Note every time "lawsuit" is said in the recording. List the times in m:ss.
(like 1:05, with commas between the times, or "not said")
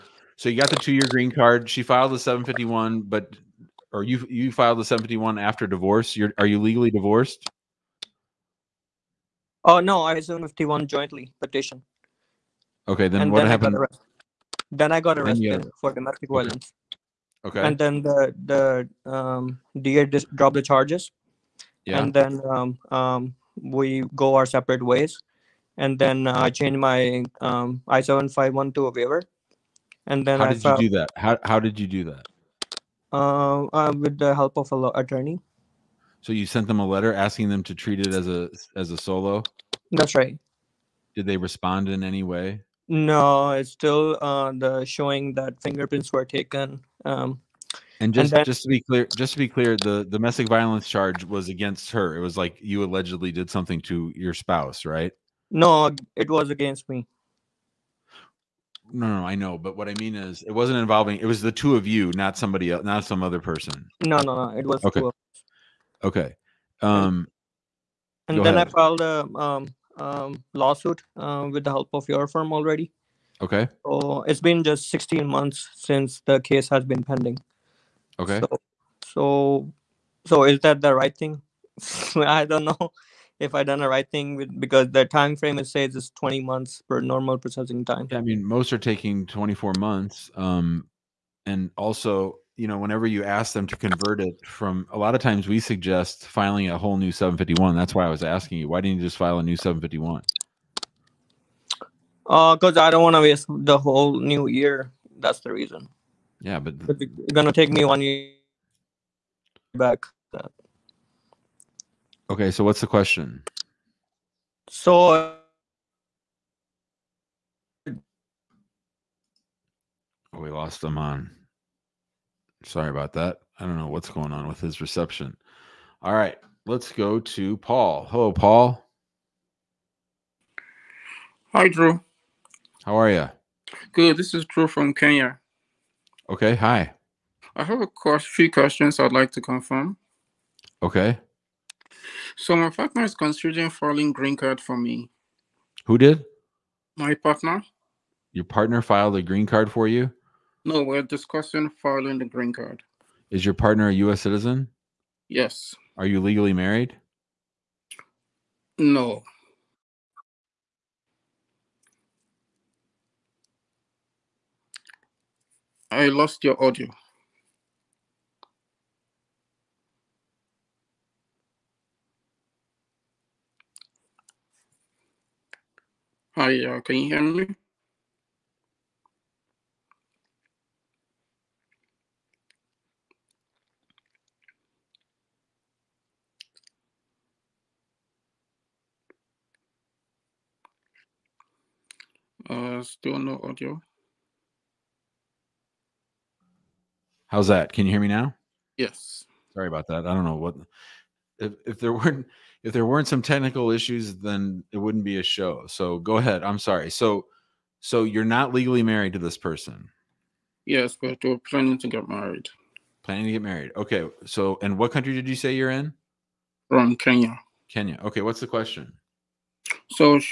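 1:10.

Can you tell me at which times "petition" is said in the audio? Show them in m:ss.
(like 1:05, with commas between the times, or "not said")
0:11.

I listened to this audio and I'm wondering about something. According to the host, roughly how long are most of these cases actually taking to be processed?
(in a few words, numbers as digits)
24 months.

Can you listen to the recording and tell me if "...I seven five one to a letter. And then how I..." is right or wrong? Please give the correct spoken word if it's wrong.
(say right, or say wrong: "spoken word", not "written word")
wrong: "waiver", not "letter".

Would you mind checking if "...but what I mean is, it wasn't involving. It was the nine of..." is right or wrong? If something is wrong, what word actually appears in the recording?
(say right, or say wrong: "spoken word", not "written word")
wrong: "two", not "nine".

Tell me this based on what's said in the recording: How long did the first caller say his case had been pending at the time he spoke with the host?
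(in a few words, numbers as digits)
16 months.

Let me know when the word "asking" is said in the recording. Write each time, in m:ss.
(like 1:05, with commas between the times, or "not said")
0:37, 1:38.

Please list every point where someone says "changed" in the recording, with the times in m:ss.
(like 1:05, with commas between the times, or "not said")
0:26.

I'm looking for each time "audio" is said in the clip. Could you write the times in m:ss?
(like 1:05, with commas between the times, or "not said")
2:46, 3:13.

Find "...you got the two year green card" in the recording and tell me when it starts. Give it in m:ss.
0:00.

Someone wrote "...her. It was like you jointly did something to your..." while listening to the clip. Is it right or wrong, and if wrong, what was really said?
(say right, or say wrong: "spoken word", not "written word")
wrong: "allegedly", not "jointly".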